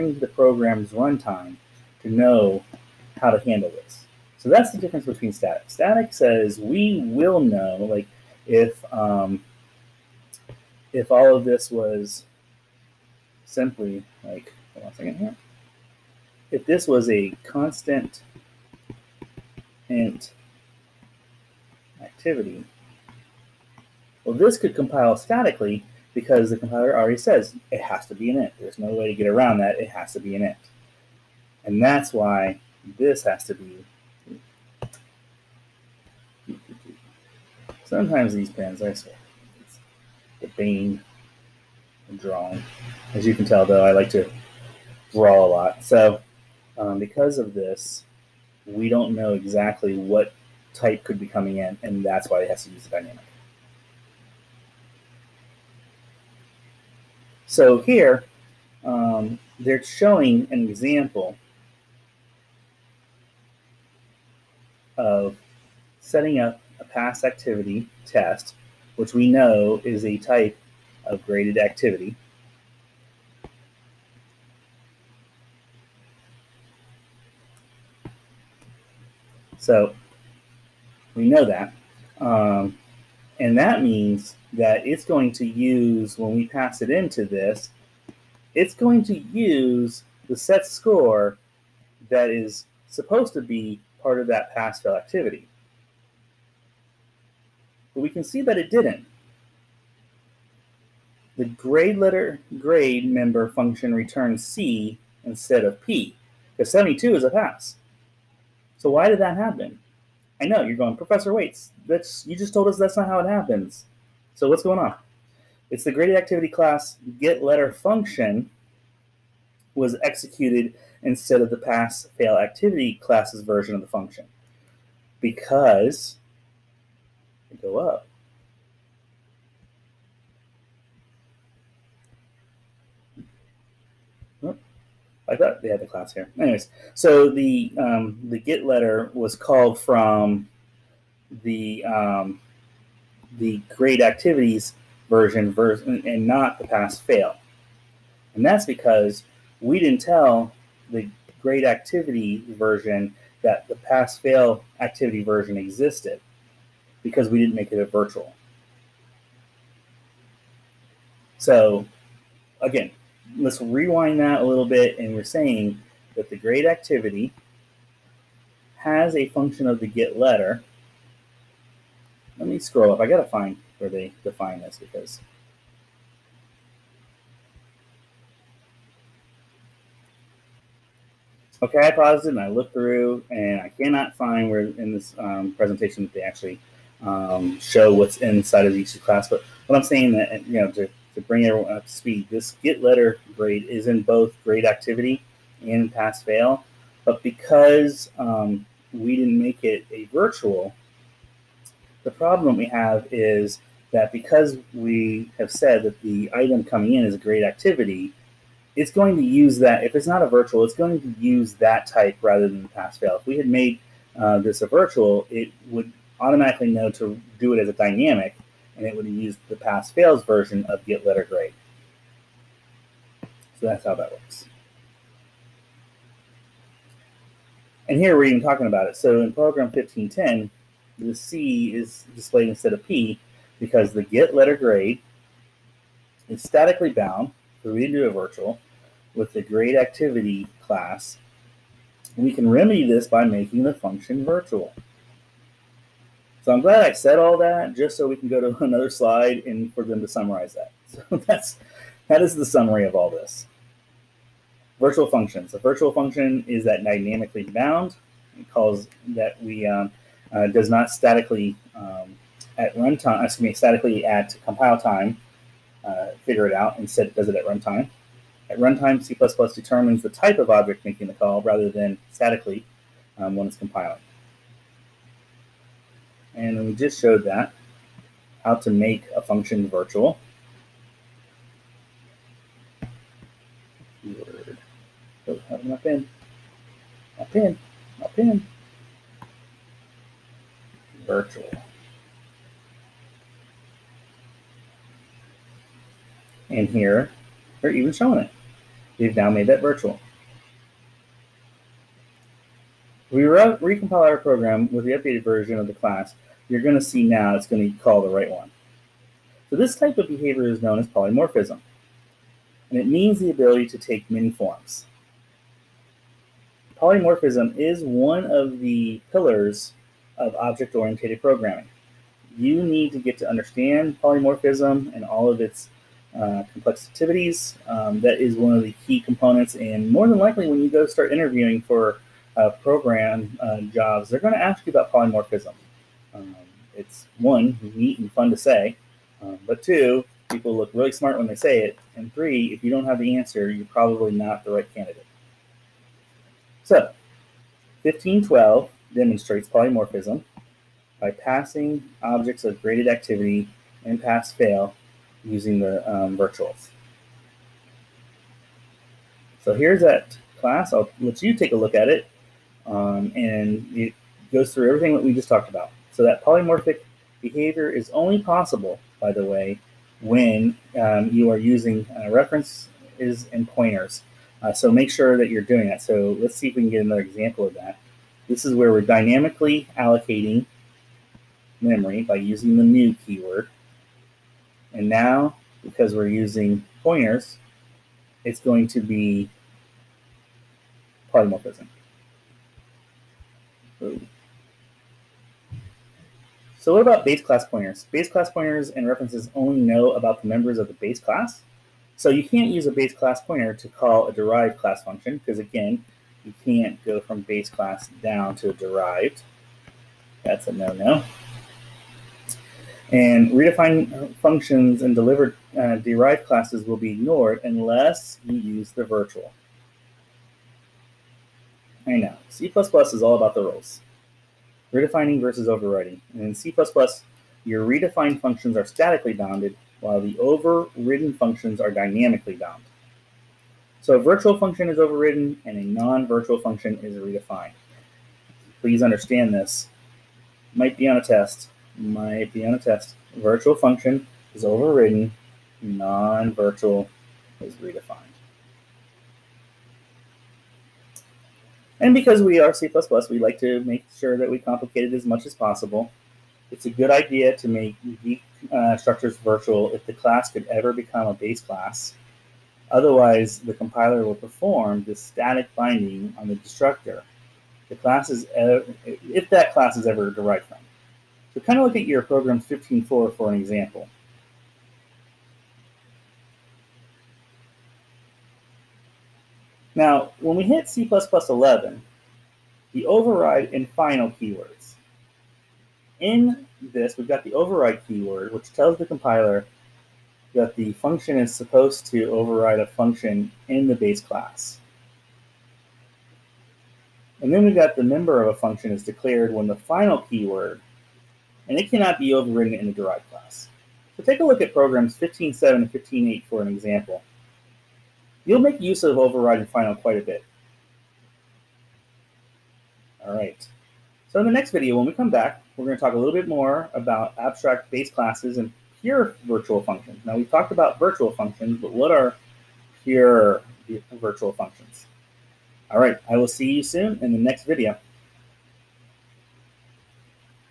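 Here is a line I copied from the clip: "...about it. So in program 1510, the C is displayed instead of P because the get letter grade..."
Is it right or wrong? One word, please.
right.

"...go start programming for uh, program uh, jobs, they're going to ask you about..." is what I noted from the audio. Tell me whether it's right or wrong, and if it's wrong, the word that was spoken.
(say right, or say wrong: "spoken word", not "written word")
wrong: "interviewing", not "programming".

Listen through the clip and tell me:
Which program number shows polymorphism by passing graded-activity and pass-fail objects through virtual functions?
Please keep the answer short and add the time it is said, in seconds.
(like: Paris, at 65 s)
1512, at 347 s.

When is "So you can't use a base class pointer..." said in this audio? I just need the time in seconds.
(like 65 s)
401 s.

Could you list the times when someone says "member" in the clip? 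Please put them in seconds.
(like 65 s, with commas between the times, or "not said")
103 s, 400 s, 497 s.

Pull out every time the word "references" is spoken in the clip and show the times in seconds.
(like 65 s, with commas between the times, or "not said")
372 s, 398 s.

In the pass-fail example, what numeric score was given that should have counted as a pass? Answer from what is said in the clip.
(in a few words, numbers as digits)
72.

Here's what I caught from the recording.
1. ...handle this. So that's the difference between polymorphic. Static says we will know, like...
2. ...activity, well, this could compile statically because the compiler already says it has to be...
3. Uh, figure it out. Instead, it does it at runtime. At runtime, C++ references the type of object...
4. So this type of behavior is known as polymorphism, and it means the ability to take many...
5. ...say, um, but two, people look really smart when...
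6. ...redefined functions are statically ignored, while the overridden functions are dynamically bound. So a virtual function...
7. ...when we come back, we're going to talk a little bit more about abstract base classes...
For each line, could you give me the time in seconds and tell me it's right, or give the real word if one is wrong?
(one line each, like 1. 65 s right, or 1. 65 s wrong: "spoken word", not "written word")
1. 3 s wrong: "static", not "polymorphic"
2. 22 s right
3. 265 s wrong: "determines", not "references"
4. 309 s right
5. 338 s right
6. 427 s wrong: "bounded", not "ignored"
7. 514 s right.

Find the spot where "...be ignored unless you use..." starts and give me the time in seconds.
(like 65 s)
416 s.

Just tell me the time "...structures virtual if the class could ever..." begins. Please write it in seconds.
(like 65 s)
458 s.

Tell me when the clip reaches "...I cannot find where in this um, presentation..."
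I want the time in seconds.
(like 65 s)
183 s.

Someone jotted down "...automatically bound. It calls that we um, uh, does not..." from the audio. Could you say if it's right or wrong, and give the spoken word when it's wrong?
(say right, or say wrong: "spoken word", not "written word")
wrong: "dynamically", not "automatically".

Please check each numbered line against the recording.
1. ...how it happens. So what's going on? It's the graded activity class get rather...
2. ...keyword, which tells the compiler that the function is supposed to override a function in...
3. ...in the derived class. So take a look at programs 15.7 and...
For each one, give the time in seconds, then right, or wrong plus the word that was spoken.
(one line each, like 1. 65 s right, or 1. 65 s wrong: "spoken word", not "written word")
1. 113 s wrong: "letter", not "rather"
2. 487 s right
3. 502 s right.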